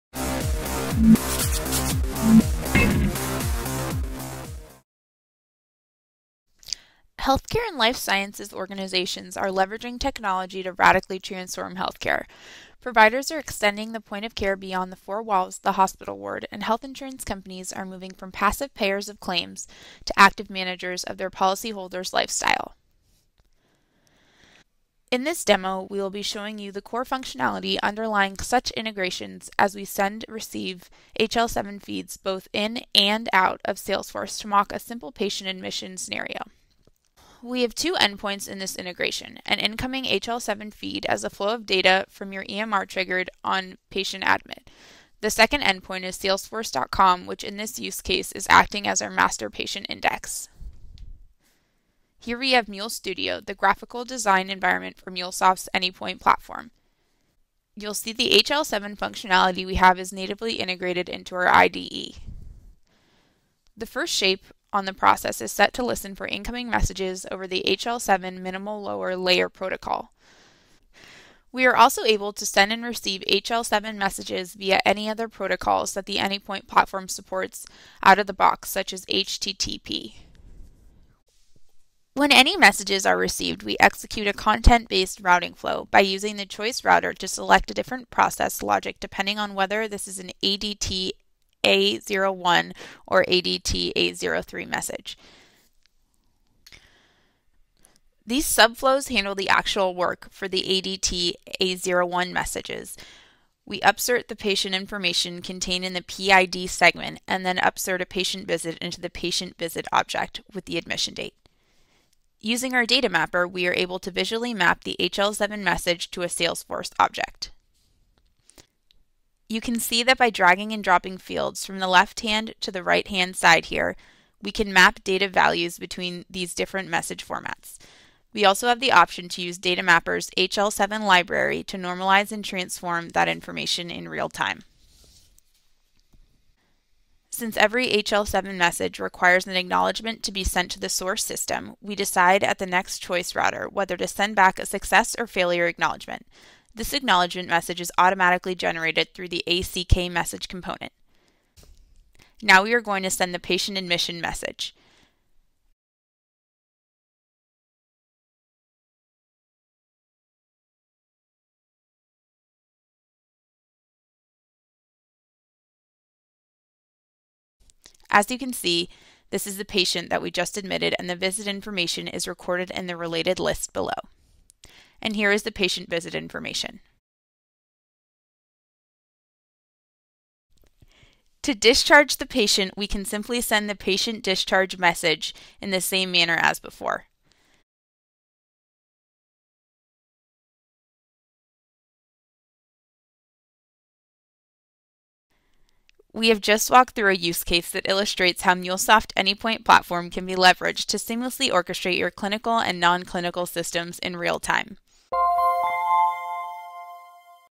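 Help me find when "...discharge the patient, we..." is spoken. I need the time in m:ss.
3:01.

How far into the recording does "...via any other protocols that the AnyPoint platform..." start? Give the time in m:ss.
1:14.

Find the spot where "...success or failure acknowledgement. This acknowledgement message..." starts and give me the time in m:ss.
2:24.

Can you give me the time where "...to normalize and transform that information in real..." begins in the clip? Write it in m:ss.
2:11.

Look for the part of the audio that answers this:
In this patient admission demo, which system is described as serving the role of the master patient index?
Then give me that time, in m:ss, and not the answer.
0:46.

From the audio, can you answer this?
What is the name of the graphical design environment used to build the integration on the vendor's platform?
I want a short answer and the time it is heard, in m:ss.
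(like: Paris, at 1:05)
Mule Studio, at 0:52.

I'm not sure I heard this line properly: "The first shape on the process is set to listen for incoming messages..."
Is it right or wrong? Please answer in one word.
right.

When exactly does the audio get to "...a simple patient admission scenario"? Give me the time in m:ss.
0:34.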